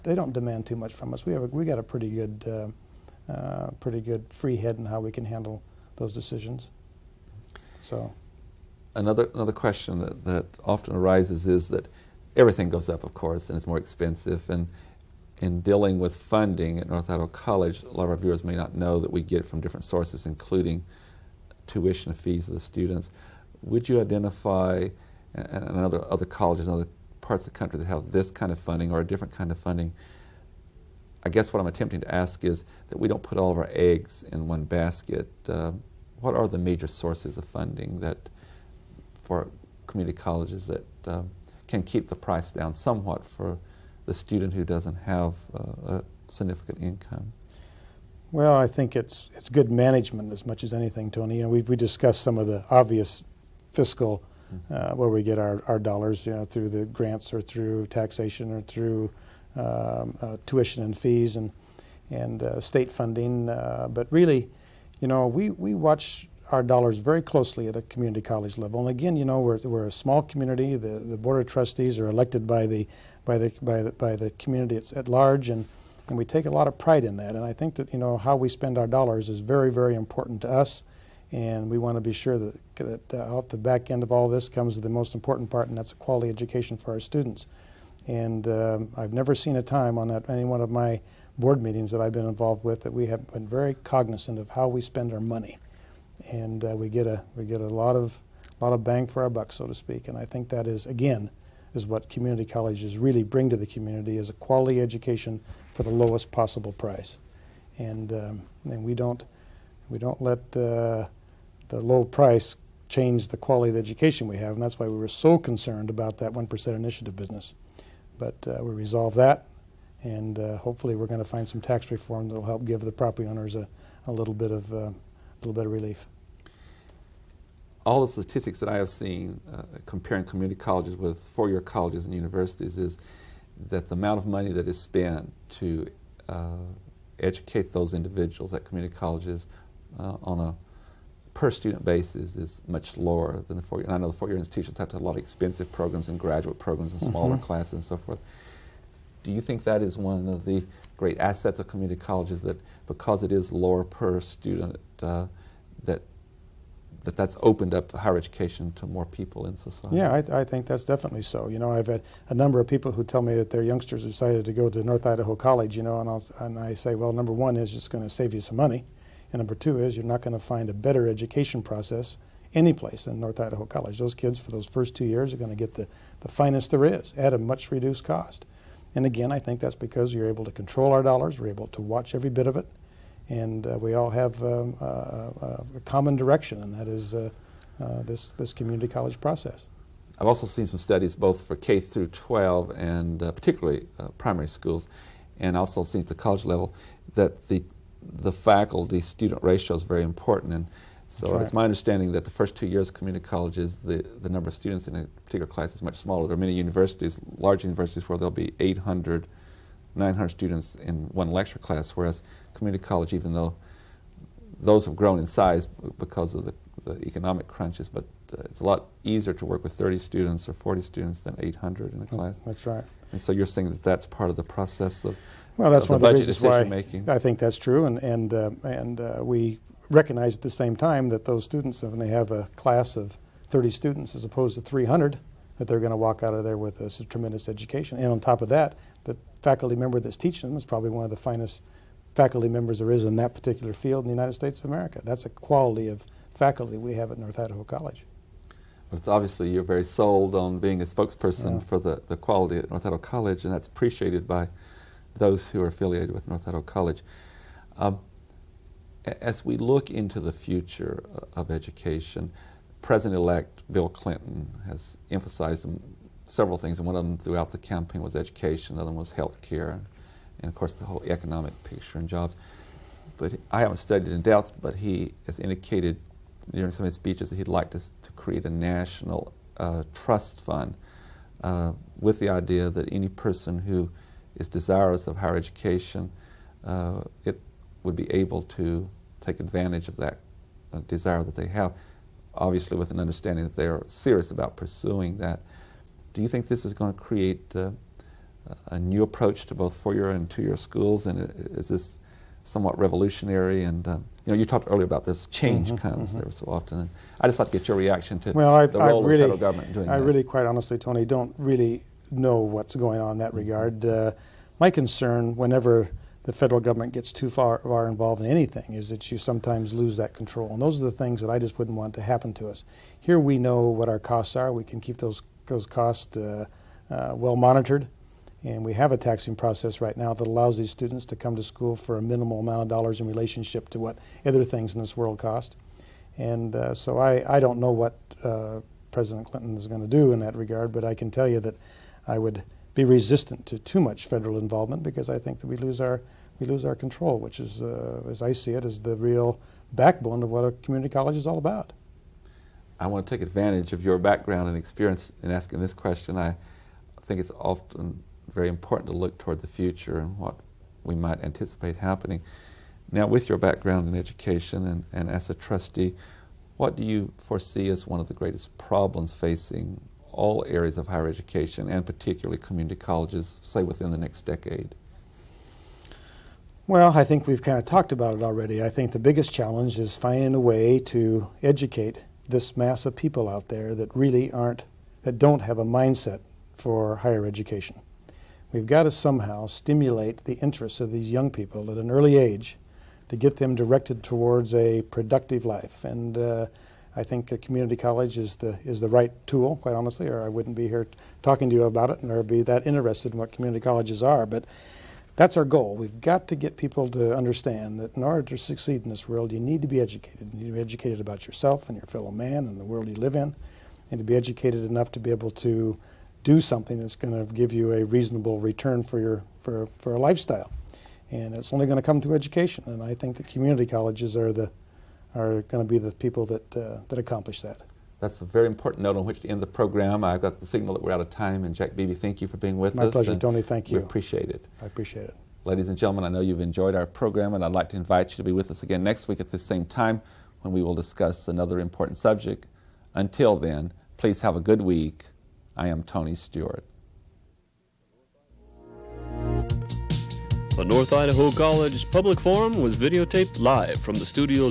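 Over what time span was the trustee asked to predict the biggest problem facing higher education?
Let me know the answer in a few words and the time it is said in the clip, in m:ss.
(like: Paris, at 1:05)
next decade, at 6:13.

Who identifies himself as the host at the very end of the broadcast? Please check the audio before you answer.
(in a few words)
Tony Stewart.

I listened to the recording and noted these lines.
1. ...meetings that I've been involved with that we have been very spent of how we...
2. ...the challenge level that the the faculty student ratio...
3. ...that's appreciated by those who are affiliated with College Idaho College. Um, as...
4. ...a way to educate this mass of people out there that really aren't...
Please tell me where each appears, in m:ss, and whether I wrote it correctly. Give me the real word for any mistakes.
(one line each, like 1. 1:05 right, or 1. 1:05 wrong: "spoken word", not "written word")
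1. 1:31 wrong: "cognizant", not "spent"
2. 3:16 wrong: "college", not "challenge"
3. 4:13 wrong: "North", not "College"
4. 6:20 right.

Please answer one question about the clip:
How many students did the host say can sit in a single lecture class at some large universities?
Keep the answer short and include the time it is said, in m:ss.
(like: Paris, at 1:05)
800 to 900, at 3:28.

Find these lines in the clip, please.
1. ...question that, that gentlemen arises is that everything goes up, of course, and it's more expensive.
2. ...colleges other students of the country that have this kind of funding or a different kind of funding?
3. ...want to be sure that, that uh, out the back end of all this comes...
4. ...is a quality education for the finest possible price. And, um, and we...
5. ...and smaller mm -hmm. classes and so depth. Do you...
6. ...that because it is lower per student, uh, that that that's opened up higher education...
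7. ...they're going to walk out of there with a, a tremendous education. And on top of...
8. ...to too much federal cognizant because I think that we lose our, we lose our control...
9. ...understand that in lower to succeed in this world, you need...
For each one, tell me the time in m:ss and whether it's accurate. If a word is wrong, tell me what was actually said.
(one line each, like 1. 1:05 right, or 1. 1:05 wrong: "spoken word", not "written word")
1. 0:09 wrong: "often", not "gentlemen"
2. 0:26 wrong: "parts", not "students"
3. 1:21 right
4. 1:44 wrong: "lowest", not "finest"
5. 2:26 wrong: "forth", not "depth"
6. 2:32 right
7. 3:55 right
8. 5:43 wrong: "involvement", not "cognizant"
9. 6:47 wrong: "order", not "lower".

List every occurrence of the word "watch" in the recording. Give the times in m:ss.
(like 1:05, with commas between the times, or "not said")
1:05, 3:01.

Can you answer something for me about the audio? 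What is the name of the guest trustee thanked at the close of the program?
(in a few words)
Jack Beebe.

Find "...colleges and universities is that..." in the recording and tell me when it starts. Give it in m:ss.
2:11.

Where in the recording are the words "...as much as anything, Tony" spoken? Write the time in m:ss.
0:50.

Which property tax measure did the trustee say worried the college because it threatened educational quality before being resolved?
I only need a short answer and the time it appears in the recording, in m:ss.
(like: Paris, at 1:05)
1% initiative, at 1:56.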